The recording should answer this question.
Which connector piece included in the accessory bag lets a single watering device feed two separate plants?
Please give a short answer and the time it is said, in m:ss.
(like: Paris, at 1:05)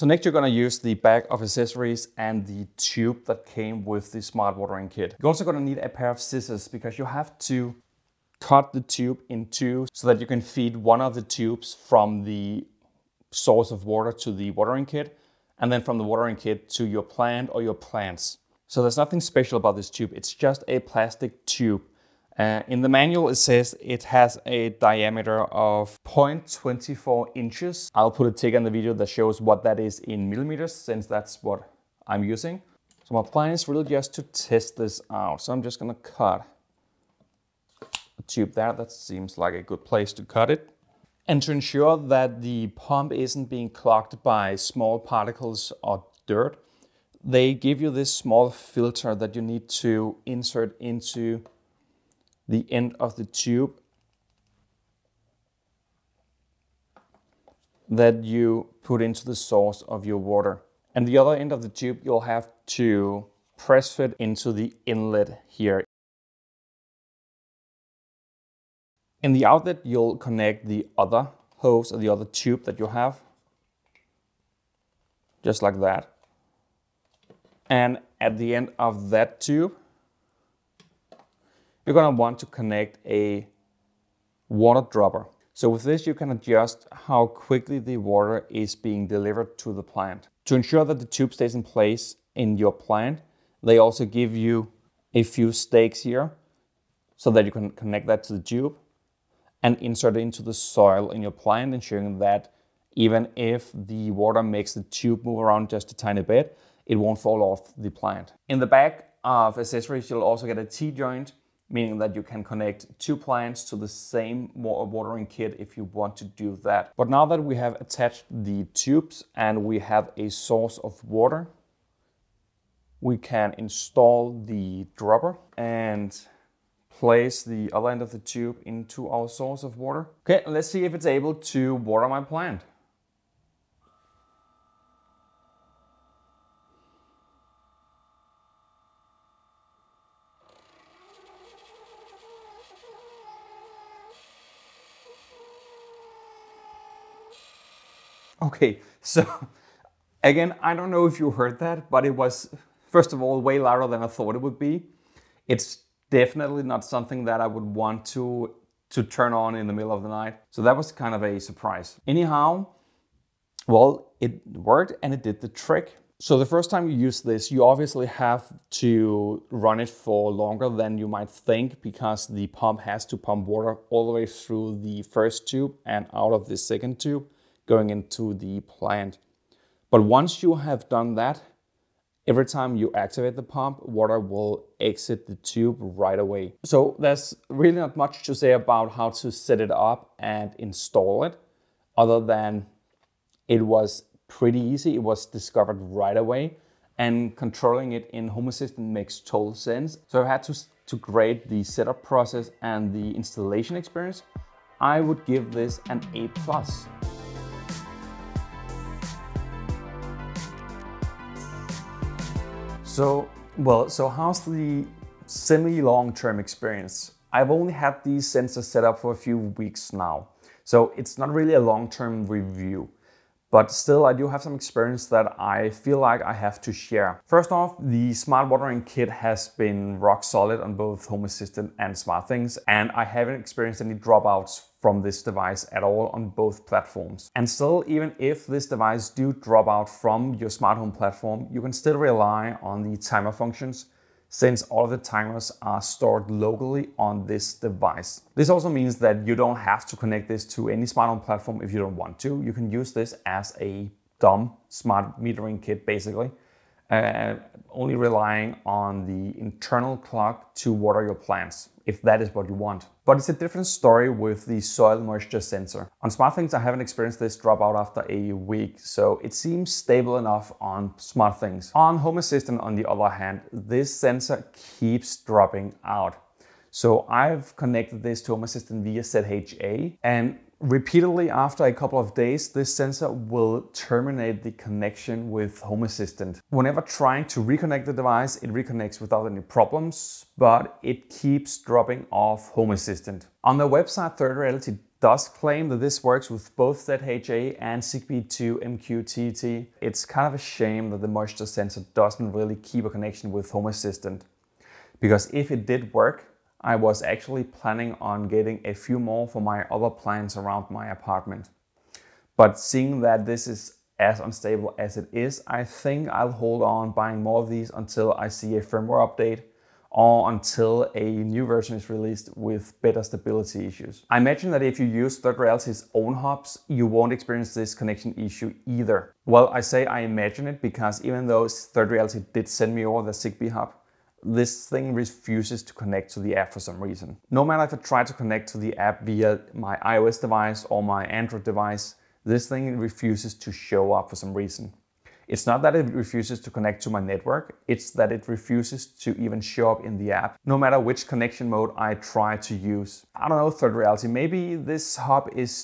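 T-joint, at 1:50.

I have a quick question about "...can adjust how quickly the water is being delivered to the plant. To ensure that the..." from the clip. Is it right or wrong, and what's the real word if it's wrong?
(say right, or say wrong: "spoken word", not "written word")
right.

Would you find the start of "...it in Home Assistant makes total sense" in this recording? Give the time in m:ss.
3:17.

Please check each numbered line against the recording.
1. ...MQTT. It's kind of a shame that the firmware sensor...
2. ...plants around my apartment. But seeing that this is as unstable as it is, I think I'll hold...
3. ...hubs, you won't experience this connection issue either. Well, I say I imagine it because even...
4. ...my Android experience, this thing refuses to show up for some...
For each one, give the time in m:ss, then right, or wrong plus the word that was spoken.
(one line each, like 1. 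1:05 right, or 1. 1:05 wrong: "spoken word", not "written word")
1. 4:58 wrong: "moisture", not "firmware"
2. 5:09 right
3. 5:26 right
4. 5:40 wrong: "device", not "experience".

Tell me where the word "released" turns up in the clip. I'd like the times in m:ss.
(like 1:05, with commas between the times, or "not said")
5:21.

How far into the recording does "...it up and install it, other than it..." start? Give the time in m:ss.
3:09.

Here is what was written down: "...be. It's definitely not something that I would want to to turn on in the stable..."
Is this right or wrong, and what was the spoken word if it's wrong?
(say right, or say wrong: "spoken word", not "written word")
wrong: "middle", not "stable".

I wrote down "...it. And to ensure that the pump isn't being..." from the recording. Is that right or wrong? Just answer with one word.
right.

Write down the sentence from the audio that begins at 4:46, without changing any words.
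Whenever trying to reconnect the device, it reconnects without any problems, but it keeps dropping off Home Assistant.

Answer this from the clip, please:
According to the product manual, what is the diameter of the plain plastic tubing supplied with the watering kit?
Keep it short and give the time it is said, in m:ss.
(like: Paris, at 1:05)
0.24 inches, at 0:26.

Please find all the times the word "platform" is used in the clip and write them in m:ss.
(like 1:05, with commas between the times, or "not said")
3:56, 4:00, 4:11.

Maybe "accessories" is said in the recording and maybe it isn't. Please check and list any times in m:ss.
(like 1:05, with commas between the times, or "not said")
0:01, 1:49.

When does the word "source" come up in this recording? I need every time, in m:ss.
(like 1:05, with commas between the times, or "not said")
0:13, 0:59, 2:00, 2:09.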